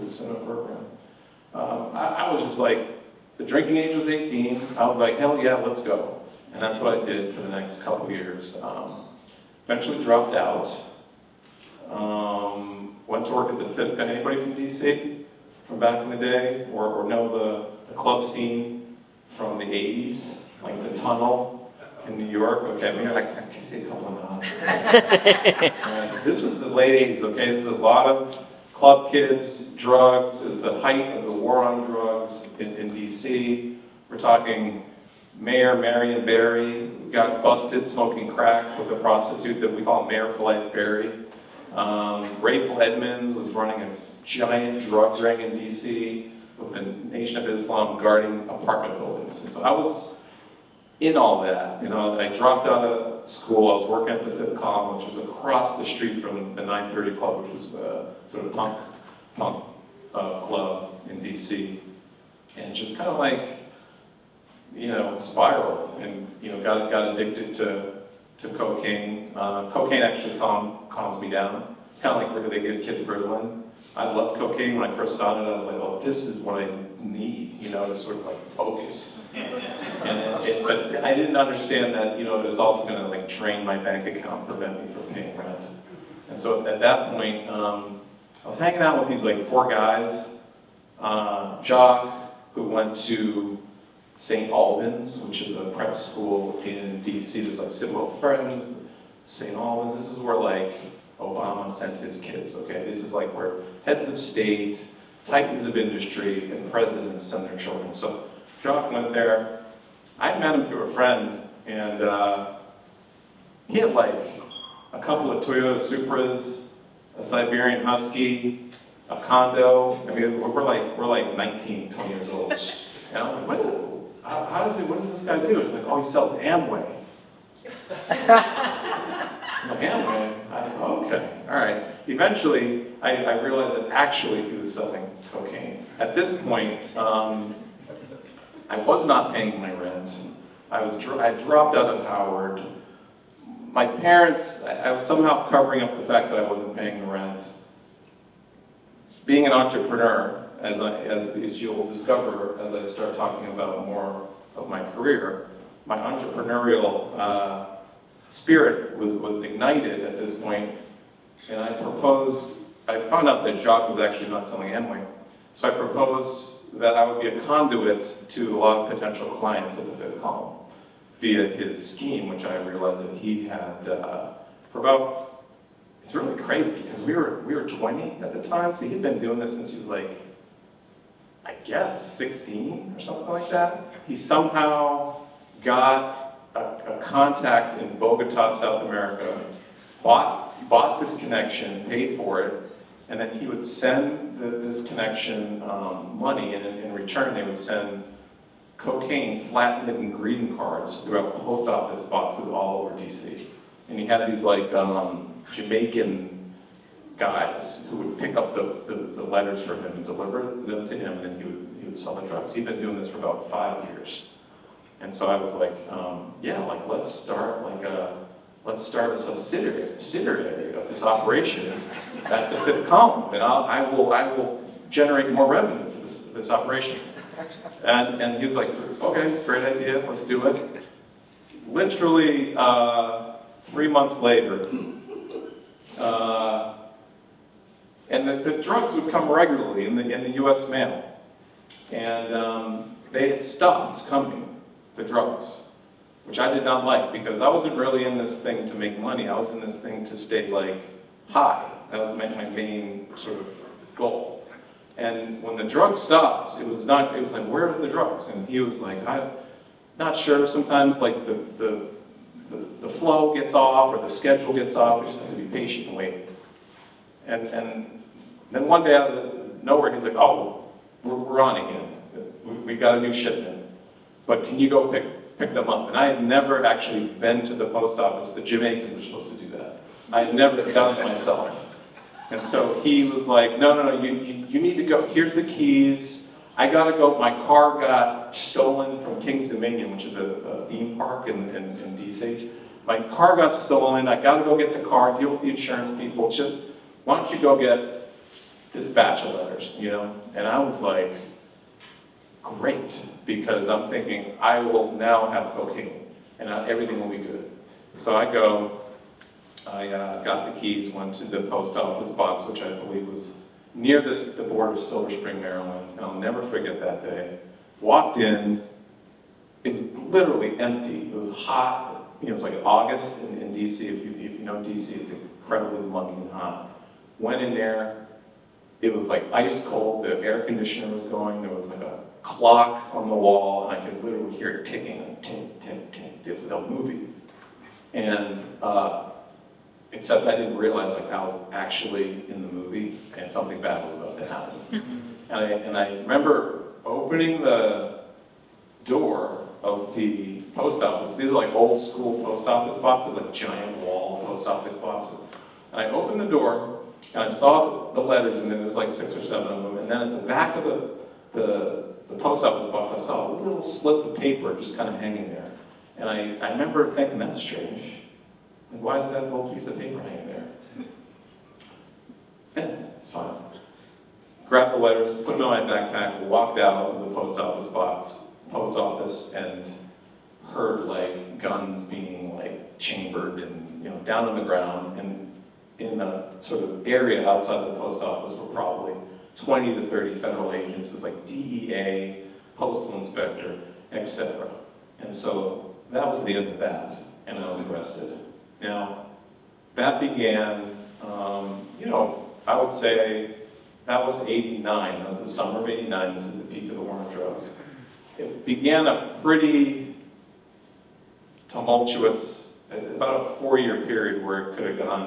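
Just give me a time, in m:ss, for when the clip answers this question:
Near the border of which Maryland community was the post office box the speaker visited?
5:14.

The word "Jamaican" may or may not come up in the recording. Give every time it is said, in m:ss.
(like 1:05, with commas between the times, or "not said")
3:25, 4:38.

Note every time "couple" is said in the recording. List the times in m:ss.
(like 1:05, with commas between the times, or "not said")
0:07, 0:23, 1:54.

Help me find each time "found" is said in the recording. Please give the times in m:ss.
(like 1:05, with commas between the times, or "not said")
2:43.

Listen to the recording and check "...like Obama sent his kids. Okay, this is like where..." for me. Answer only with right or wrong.
right.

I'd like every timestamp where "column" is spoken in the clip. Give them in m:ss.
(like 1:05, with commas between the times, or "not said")
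0:13, 0:54, 2:50, 3:42.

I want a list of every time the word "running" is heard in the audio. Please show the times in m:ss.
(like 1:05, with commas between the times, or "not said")
0:43.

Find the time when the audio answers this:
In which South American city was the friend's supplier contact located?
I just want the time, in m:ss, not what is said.
3:07.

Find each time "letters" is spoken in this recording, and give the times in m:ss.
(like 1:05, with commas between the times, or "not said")
3:29, 4:59, 5:57, 6:14.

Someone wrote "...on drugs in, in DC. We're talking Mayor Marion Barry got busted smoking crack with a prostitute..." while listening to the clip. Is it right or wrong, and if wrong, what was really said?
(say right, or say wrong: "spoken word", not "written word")
right.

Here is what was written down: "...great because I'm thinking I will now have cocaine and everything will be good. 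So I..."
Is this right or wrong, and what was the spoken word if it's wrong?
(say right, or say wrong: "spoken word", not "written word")
right.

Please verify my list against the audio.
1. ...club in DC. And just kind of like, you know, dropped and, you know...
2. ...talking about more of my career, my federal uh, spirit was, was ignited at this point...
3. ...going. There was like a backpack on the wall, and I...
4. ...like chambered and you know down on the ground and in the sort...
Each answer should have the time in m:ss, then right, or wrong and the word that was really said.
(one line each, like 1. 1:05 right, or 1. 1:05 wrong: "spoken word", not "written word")
1. 1:00 wrong: "spiraled", not "dropped"
2. 2:33 wrong: "entrepreneurial", not "federal"
3. 5:31 wrong: "clock", not "backpack"
4. 6:22 right.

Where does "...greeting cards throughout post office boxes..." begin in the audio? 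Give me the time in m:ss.
3:20.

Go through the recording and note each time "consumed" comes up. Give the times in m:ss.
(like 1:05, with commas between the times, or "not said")
not said.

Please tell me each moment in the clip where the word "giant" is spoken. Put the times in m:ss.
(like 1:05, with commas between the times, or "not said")
0:44, 5:53.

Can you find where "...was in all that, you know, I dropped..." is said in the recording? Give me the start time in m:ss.
0:49.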